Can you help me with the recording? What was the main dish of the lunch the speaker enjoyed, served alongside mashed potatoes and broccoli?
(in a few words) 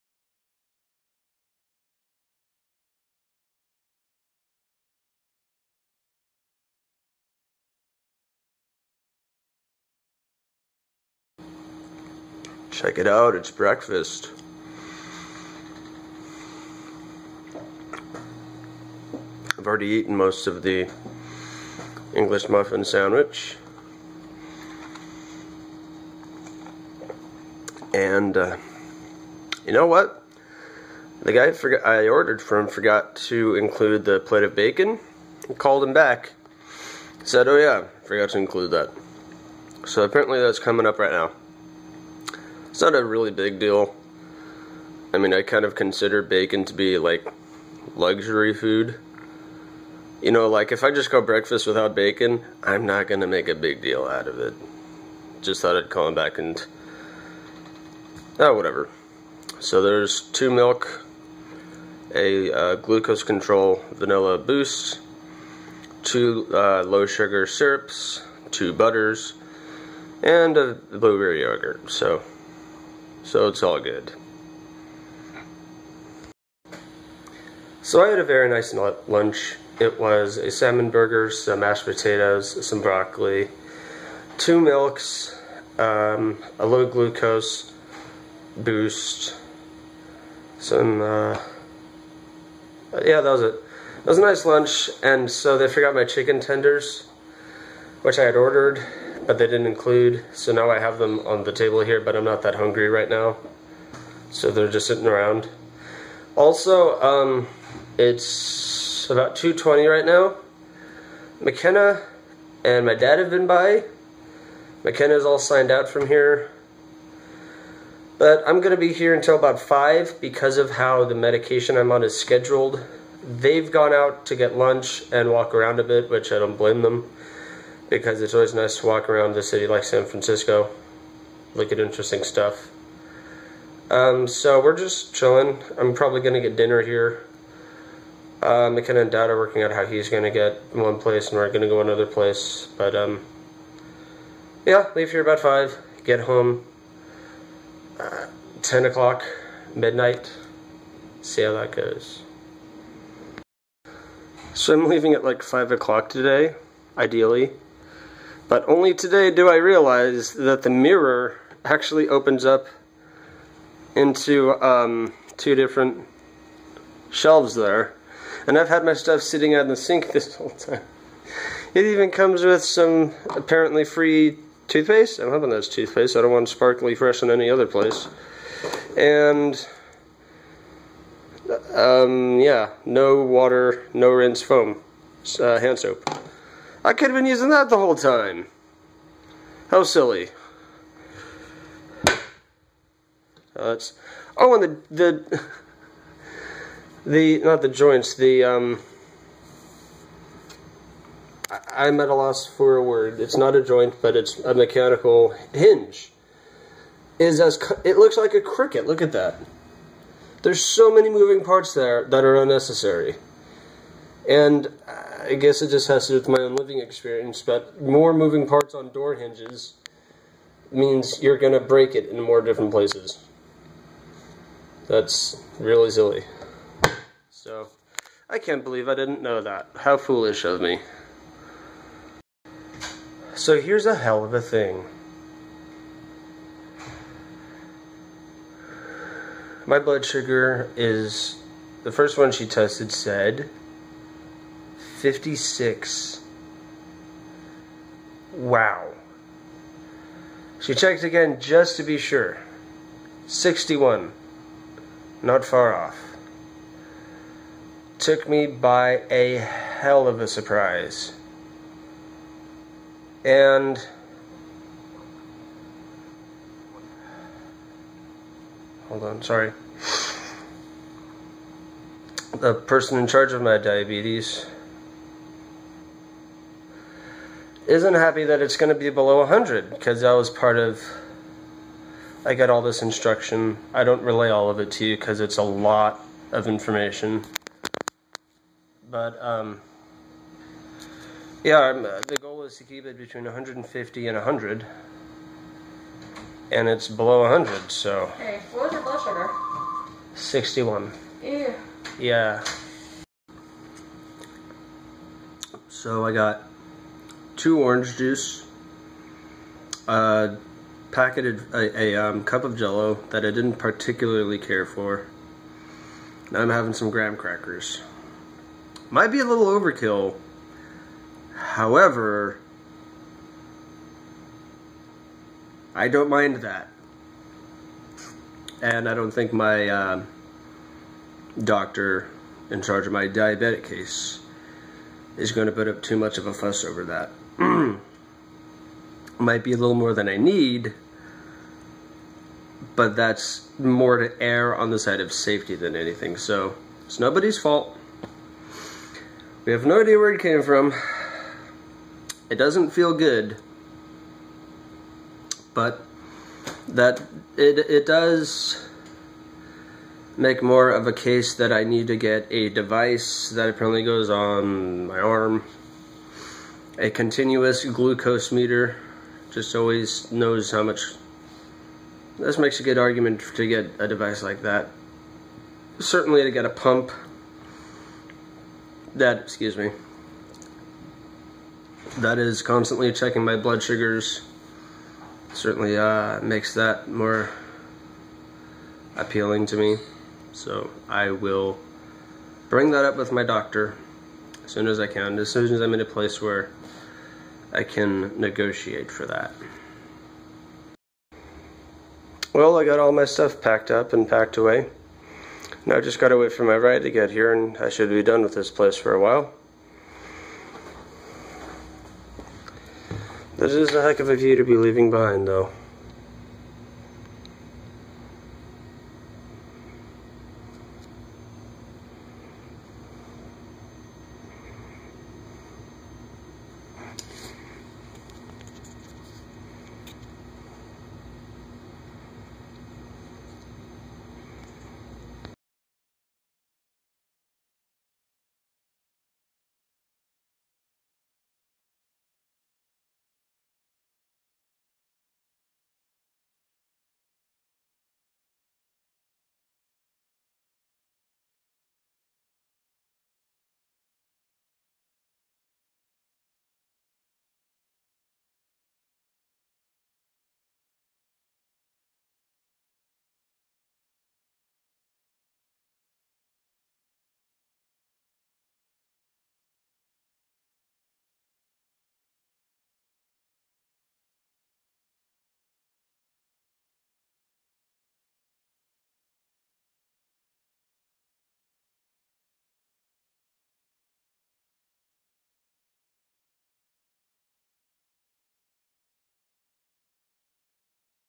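Salmon burger.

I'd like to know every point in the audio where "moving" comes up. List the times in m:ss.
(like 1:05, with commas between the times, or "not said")
3:31, 3:38.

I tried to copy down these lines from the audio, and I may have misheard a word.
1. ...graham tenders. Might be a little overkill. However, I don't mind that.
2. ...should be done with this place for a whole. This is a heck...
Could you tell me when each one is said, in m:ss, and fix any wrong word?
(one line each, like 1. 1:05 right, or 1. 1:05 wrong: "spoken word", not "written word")
1. 5:16 wrong: "crackers", not "tenders"
2. 6:47 wrong: "while", not "whole".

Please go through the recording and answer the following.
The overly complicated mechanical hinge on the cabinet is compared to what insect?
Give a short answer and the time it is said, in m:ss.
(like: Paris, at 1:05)
Cricket, at 3:28.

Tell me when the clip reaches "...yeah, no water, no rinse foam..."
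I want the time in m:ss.
3:02.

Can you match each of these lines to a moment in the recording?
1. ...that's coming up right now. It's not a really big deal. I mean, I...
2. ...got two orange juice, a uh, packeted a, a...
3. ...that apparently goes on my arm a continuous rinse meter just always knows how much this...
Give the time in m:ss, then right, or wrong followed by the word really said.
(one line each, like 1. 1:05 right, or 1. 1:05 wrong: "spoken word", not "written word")
1. 0:40 right
2. 5:06 right
3. 6:03 wrong: "glucose", not "rinse".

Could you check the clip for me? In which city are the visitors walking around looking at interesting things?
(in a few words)
San Francisco.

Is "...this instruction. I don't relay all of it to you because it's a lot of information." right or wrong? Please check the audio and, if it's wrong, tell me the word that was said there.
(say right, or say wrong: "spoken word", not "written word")
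right.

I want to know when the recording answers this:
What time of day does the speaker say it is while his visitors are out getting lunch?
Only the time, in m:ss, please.
1:49.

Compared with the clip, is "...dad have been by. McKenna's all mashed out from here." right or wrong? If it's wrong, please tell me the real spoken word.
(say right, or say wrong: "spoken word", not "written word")
wrong: "signed", not "mashed".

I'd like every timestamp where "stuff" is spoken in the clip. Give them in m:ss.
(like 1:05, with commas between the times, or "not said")
2:12, 2:48, 6:43.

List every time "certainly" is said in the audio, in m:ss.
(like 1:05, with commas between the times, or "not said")
6:15, 6:25.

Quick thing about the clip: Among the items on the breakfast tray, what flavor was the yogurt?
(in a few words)
Blueberry.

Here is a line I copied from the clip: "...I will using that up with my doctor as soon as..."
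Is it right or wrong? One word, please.
wrong.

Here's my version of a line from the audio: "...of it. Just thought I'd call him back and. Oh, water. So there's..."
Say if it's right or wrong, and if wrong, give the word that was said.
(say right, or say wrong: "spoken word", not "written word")
wrong: "whatever", not "water".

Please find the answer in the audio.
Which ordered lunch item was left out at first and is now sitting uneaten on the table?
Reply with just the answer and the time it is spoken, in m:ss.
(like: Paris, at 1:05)
Chicken tenders, at 1:36.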